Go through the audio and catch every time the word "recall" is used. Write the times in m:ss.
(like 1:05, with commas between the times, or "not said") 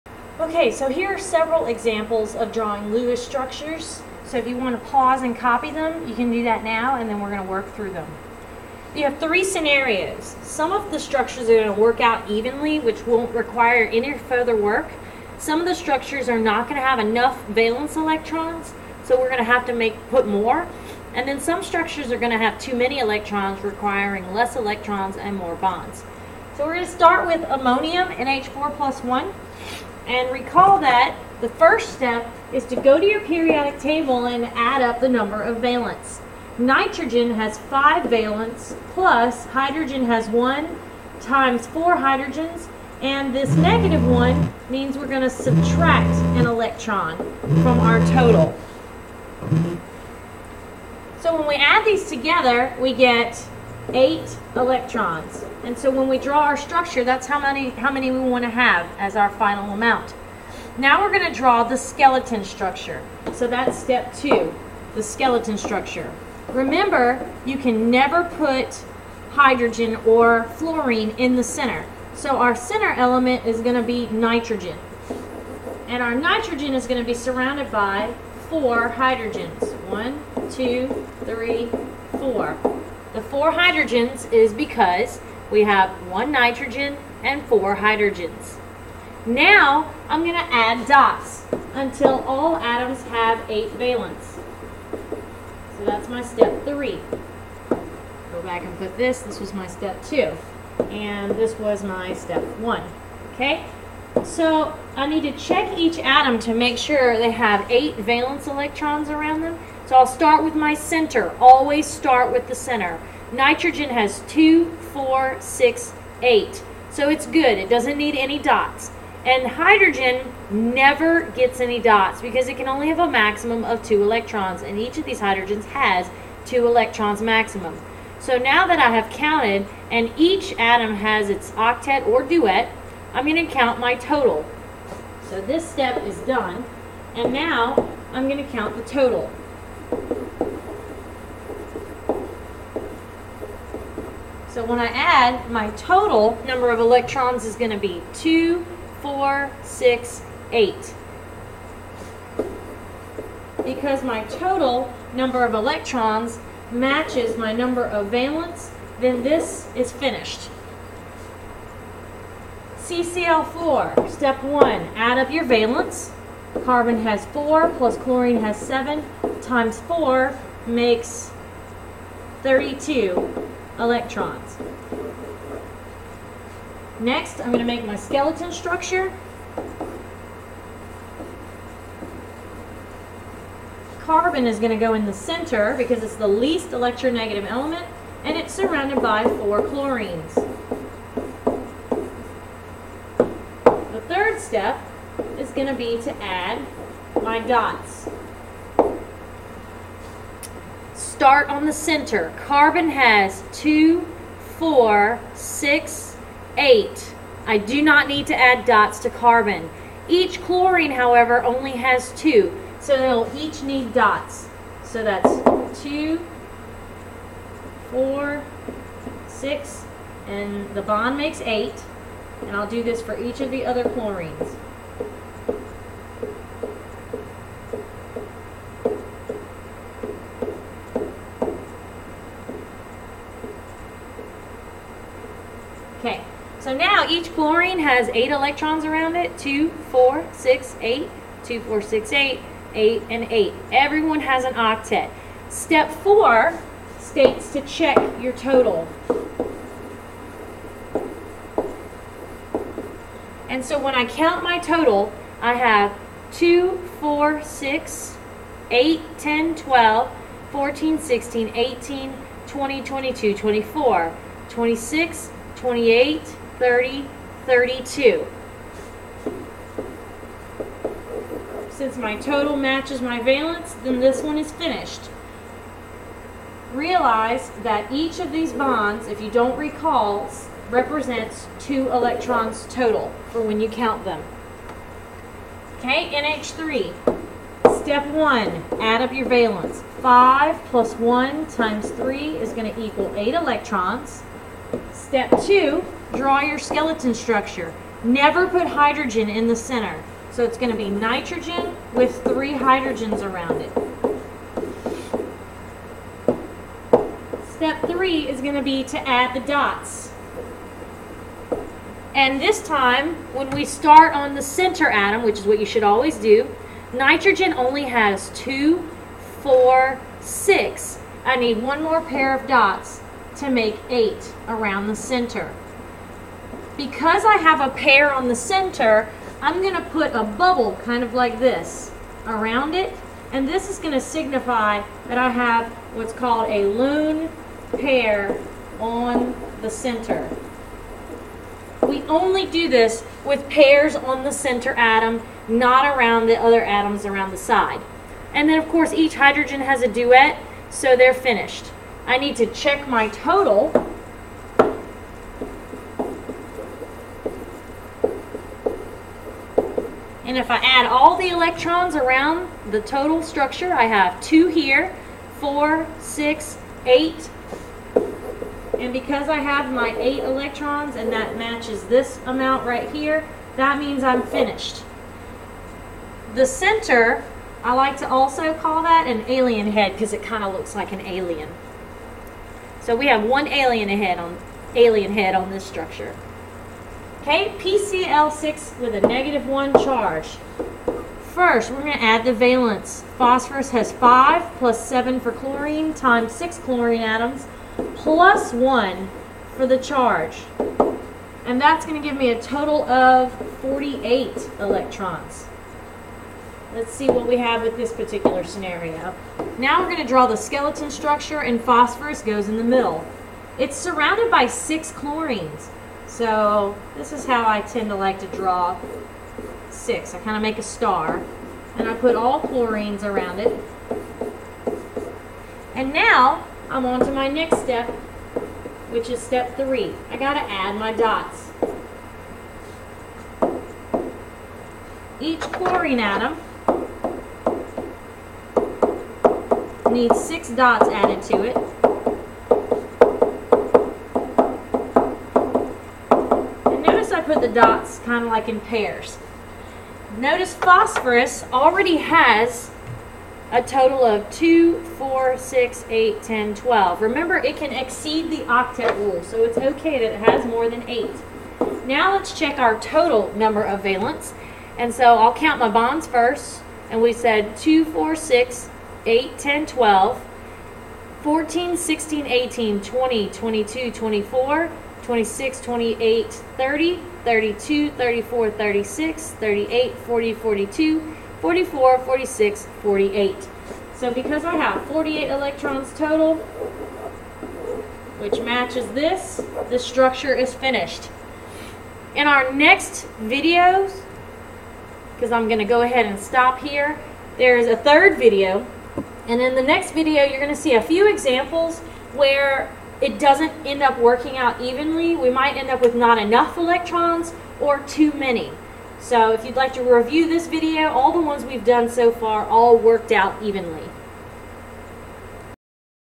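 0:30, 4:39.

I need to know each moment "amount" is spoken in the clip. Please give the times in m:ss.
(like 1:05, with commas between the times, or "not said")
0:59, 6:12.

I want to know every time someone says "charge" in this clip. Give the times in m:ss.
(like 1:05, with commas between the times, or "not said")
6:29, 6:39.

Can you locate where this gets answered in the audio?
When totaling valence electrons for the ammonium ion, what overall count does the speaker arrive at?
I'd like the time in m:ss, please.
0:52.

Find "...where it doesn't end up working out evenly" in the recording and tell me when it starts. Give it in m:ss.
8:22.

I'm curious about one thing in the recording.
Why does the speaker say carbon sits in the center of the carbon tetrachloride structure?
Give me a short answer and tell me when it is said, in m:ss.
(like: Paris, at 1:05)
least electronegative element, at 3:06.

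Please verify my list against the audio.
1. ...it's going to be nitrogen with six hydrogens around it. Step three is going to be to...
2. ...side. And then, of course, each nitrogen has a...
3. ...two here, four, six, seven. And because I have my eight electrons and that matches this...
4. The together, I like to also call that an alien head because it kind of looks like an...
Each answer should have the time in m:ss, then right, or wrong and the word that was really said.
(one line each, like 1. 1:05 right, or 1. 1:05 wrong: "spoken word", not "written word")
1. 5:00 wrong: "three", not "six"
2. 5:47 wrong: "hydrogen", not "nitrogen"
3. 6:04 wrong: "eight", not "seven"
4. 6:16 wrong: "center", not "together".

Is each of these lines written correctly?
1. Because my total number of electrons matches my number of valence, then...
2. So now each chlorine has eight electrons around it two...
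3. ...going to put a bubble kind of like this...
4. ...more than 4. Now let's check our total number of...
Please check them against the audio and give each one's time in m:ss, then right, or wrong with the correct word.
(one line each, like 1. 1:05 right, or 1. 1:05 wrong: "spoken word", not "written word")
1. 2:33 right
2. 3:56 right
3. 5:29 right
4. 7:40 wrong: "8", not "4".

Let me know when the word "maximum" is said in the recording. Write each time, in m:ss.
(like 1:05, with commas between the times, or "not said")
2:03, 2:07.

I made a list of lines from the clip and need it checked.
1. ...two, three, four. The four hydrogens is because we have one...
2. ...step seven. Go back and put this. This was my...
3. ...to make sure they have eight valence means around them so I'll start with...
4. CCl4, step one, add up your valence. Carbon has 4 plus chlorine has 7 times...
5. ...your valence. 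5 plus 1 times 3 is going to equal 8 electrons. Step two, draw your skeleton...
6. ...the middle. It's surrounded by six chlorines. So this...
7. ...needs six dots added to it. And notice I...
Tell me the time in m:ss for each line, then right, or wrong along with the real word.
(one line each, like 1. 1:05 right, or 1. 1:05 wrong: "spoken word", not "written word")
1. 1:20 right
2. 1:36 wrong: "three", not "seven"
3. 1:46 wrong: "electrons", not "means"
4. 2:42 right
5. 4:49 right
6. 6:52 right
7. 7:19 right.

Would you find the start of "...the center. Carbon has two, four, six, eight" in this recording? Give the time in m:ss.
3:21.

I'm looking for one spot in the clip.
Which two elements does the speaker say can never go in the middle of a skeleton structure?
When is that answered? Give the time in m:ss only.
1:09.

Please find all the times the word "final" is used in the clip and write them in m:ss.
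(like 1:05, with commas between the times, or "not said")
0:59.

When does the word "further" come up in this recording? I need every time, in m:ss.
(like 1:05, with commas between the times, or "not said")
0:14.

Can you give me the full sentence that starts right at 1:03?
So that's step two, the skeleton structure.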